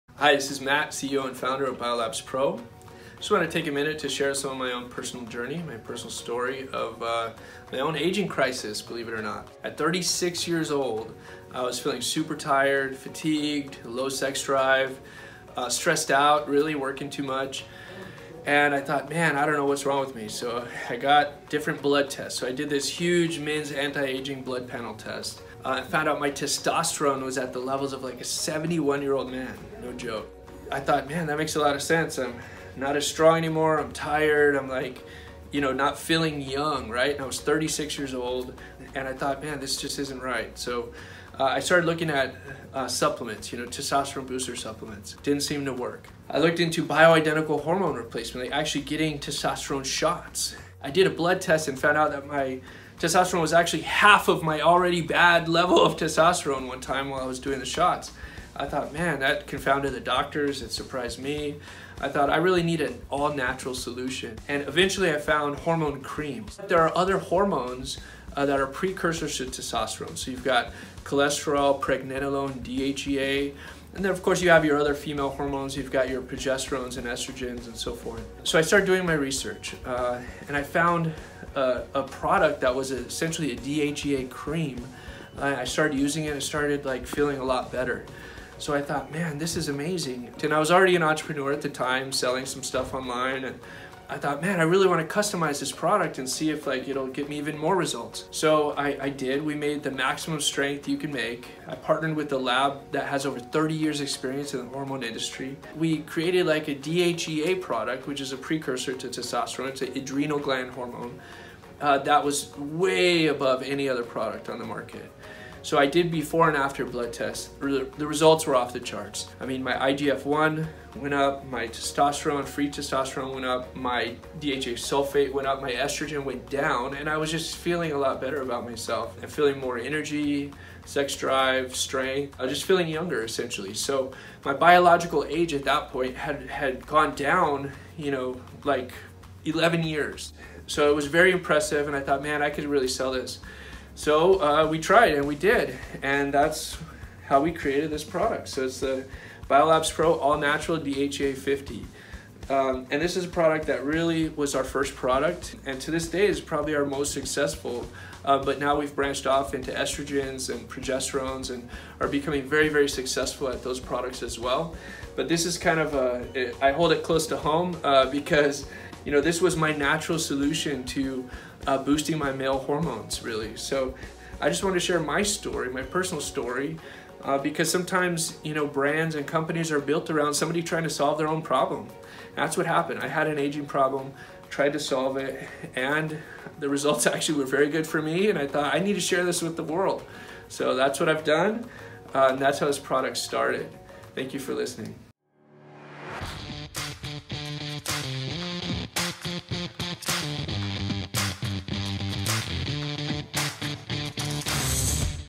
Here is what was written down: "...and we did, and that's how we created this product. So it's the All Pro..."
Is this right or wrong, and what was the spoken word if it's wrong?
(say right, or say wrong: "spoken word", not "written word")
wrong: "Biolabs", not "All".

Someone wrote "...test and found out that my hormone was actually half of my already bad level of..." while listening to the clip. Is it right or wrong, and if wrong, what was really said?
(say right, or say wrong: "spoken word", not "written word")
wrong: "testosterone", not "hormone".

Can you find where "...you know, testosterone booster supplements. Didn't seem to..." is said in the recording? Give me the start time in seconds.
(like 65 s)
43 s.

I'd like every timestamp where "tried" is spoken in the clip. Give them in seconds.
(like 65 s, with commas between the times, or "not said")
144 s, 184 s.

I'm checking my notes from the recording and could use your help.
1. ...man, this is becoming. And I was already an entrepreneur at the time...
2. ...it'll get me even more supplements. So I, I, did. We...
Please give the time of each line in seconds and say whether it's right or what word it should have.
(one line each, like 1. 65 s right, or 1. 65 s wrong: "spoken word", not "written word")
1. 89 s wrong: "amazing", not "becoming"
2. 96 s wrong: "results", not "supplements".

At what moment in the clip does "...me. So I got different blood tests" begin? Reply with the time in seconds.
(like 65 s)
20 s.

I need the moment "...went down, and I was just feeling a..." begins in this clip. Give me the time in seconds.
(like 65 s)
126 s.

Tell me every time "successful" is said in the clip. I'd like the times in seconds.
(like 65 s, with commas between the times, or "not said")
157 s, 162 s.